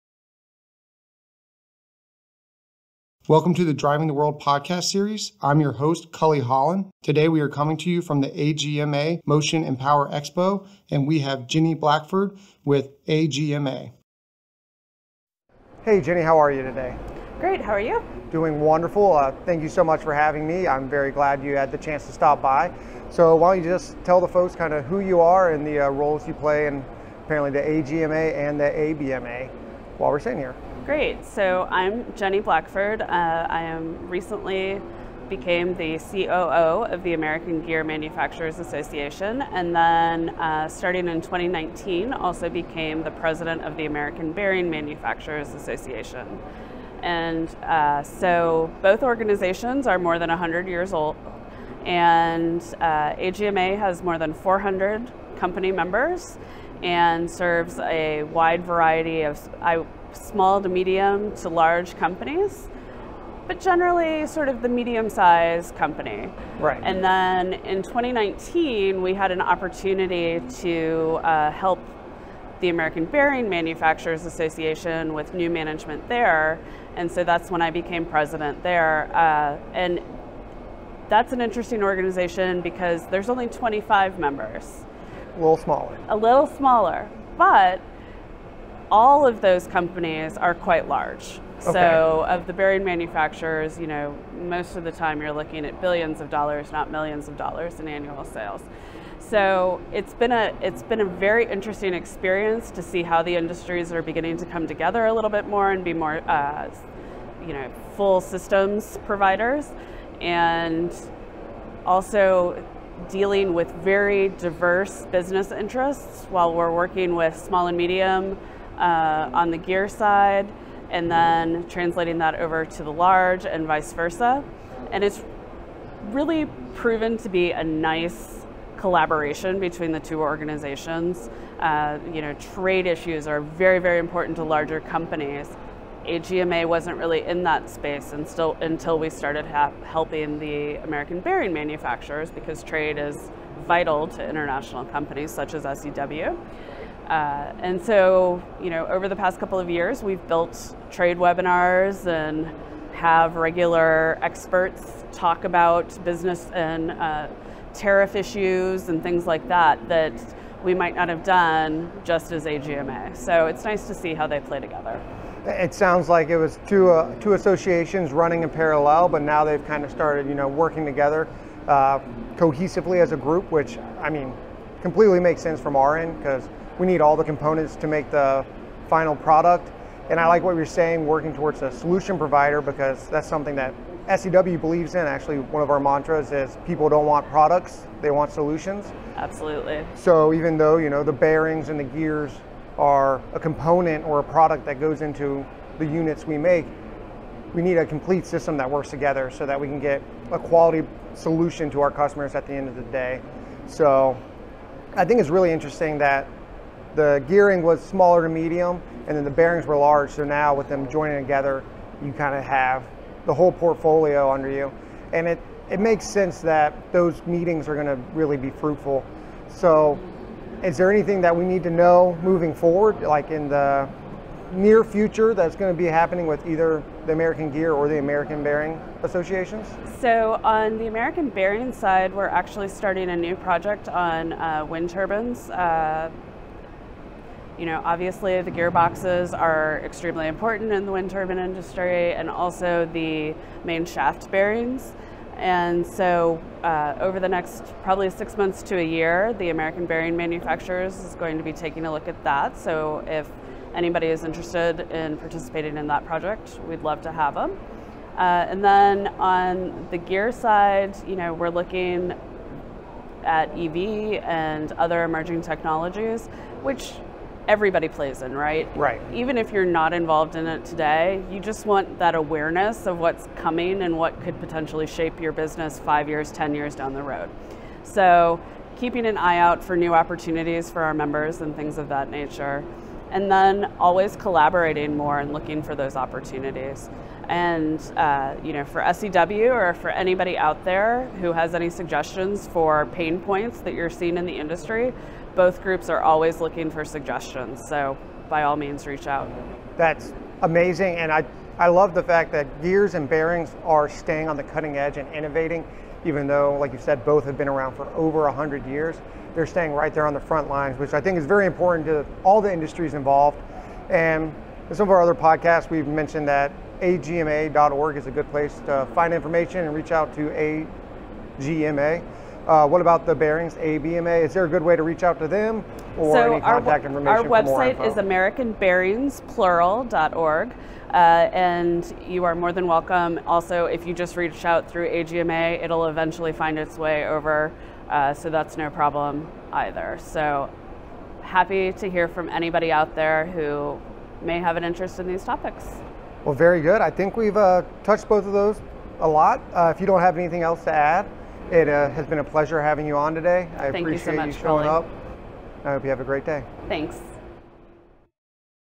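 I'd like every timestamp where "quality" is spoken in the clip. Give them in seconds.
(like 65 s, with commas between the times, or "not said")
200 s.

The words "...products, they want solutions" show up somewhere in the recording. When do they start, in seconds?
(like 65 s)
187 s.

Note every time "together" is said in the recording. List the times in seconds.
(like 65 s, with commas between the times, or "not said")
104 s, 164 s, 170 s, 198 s, 211 s.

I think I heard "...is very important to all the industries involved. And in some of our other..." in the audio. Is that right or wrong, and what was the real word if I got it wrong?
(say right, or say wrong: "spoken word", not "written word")
right.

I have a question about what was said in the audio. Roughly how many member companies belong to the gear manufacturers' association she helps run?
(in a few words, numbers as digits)
more than 400.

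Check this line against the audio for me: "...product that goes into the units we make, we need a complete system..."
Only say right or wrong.
right.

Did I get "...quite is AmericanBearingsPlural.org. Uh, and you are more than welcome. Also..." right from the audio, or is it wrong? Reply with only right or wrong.
wrong.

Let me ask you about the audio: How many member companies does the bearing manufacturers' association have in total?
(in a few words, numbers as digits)
25.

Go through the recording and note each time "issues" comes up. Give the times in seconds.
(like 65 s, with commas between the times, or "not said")
132 s, 158 s.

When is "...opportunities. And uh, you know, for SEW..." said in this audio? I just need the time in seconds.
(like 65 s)
285 s.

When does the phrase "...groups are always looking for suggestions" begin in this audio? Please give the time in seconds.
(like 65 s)
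295 s.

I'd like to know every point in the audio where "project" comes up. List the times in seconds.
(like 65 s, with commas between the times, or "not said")
233 s, 256 s.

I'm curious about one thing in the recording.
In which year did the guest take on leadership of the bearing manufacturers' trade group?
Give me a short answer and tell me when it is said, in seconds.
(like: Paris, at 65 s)
2019, at 40 s.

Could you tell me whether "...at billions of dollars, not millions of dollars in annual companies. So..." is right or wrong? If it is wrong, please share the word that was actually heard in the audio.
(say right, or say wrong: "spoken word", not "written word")
wrong: "sales", not "companies".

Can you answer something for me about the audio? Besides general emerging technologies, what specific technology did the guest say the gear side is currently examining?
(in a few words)
EV.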